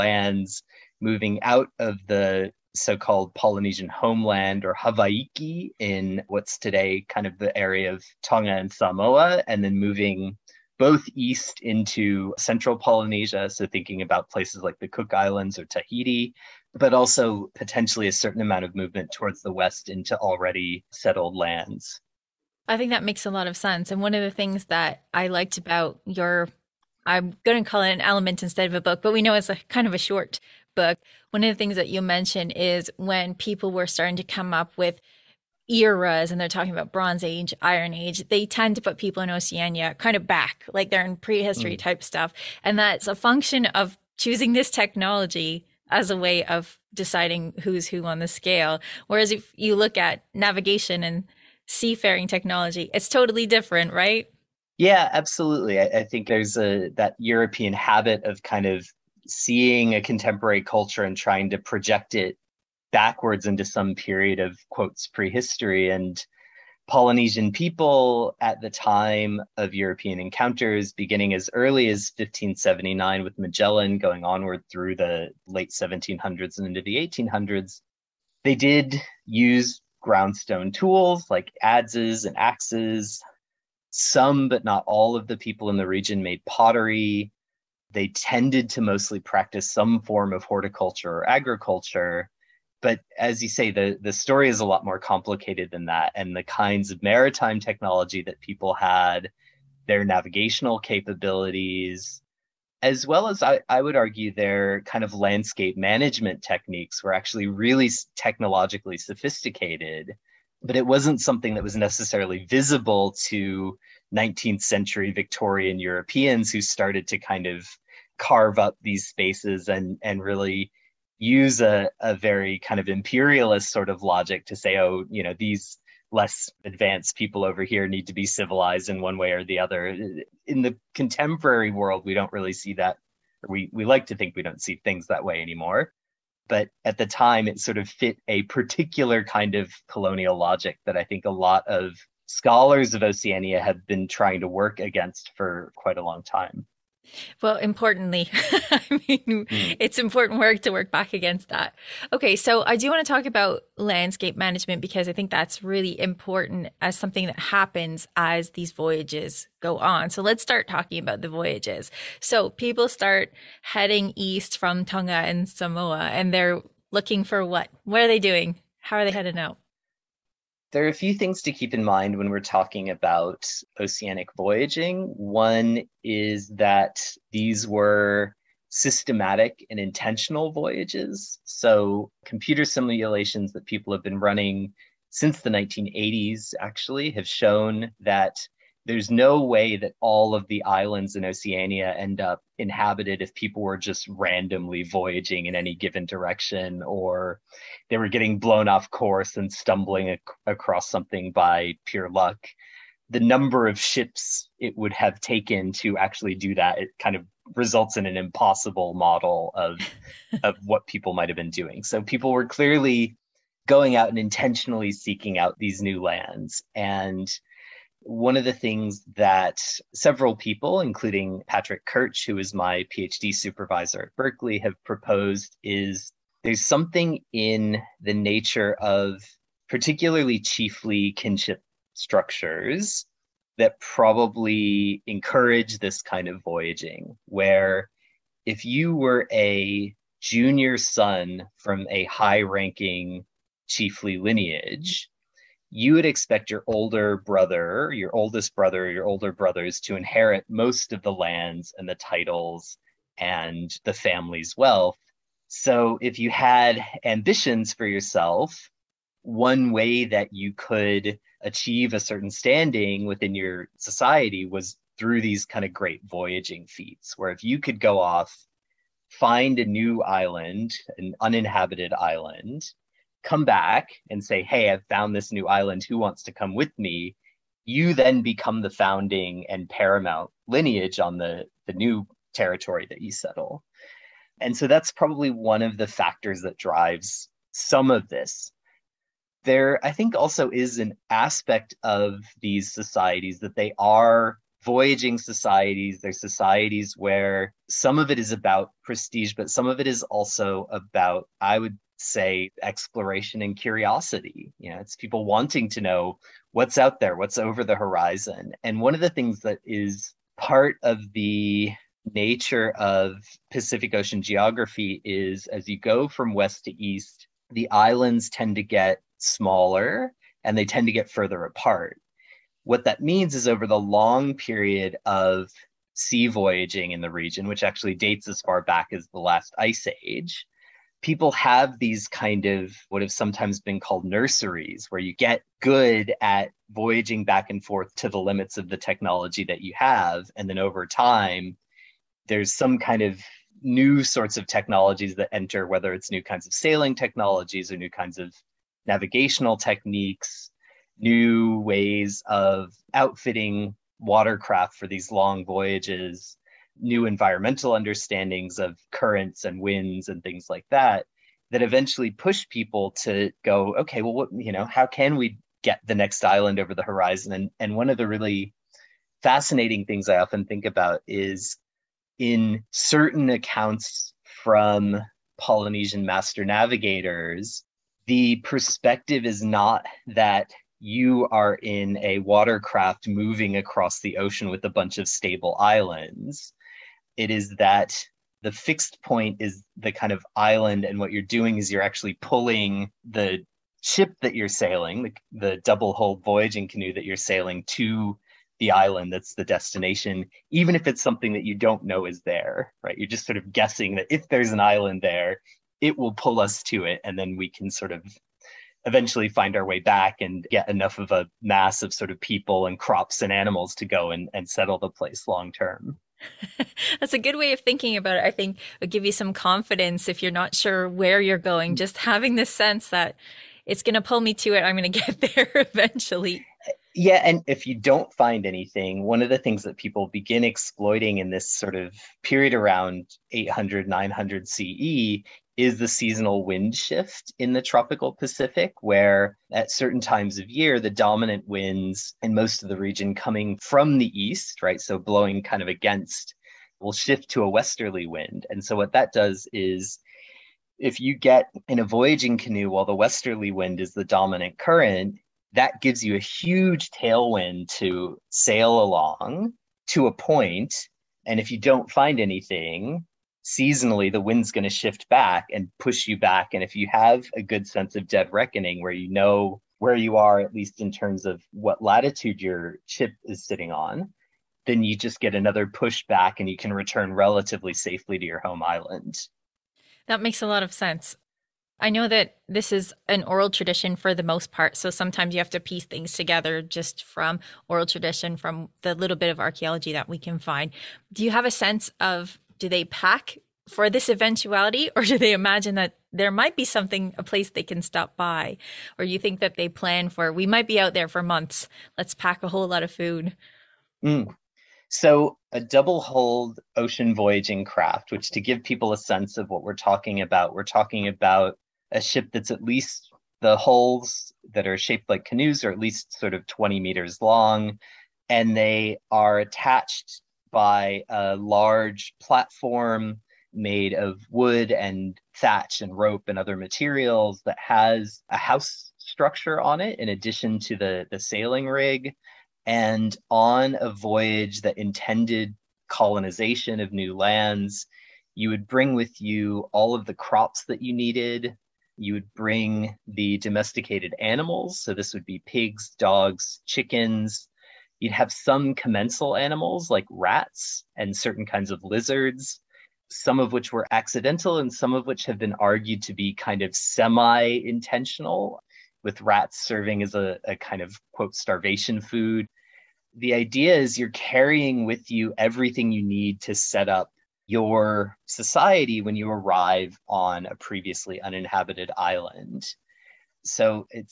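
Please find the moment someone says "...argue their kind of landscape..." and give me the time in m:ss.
1:43.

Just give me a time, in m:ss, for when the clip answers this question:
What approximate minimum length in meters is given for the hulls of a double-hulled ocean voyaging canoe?
8:36.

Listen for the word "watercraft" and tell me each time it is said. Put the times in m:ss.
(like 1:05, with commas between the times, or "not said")
5:53, 6:22.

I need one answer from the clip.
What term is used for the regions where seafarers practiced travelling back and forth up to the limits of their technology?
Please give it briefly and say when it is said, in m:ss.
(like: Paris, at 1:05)
nurseries, at 5:34.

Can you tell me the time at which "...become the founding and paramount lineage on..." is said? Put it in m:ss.
4:38.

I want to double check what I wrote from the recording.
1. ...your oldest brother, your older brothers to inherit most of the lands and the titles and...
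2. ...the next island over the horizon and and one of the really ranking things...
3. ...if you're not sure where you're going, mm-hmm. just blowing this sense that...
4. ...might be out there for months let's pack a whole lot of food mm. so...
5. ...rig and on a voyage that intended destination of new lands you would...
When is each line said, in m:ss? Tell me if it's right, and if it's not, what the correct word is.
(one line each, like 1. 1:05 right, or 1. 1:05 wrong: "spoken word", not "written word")
1. 4:07 right
2. 6:05 wrong: "fascinating", not "ranking"
3. 7:00 wrong: "having", not "blowing"
4. 8:20 right
5. 8:51 wrong: "colonization", not "destination".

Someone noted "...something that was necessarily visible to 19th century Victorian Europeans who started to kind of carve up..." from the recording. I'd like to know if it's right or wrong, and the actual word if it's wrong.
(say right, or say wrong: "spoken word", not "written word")
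right.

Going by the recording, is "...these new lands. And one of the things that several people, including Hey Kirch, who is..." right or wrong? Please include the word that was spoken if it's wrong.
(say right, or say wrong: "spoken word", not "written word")
wrong: "Patrick", not "Hey".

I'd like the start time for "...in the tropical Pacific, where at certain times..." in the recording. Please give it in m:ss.
7:17.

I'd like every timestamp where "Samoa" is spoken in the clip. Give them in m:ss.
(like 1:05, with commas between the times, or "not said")
0:08, 2:45.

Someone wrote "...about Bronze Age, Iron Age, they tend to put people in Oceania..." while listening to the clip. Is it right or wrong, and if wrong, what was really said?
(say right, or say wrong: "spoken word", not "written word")
right.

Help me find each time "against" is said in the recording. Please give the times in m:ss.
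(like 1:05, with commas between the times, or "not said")
2:24, 2:31, 7:25.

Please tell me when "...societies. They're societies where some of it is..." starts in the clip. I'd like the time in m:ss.
4:55.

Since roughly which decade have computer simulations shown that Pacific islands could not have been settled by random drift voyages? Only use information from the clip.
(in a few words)
1980s.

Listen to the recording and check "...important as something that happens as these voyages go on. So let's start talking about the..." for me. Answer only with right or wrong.
right.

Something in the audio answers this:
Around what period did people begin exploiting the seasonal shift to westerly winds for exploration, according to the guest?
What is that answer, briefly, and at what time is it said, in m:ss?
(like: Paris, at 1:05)
800 to 900 CE, at 7:13.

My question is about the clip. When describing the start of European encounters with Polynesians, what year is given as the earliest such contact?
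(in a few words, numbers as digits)
1579.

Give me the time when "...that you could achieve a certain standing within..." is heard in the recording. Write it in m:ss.
4:20.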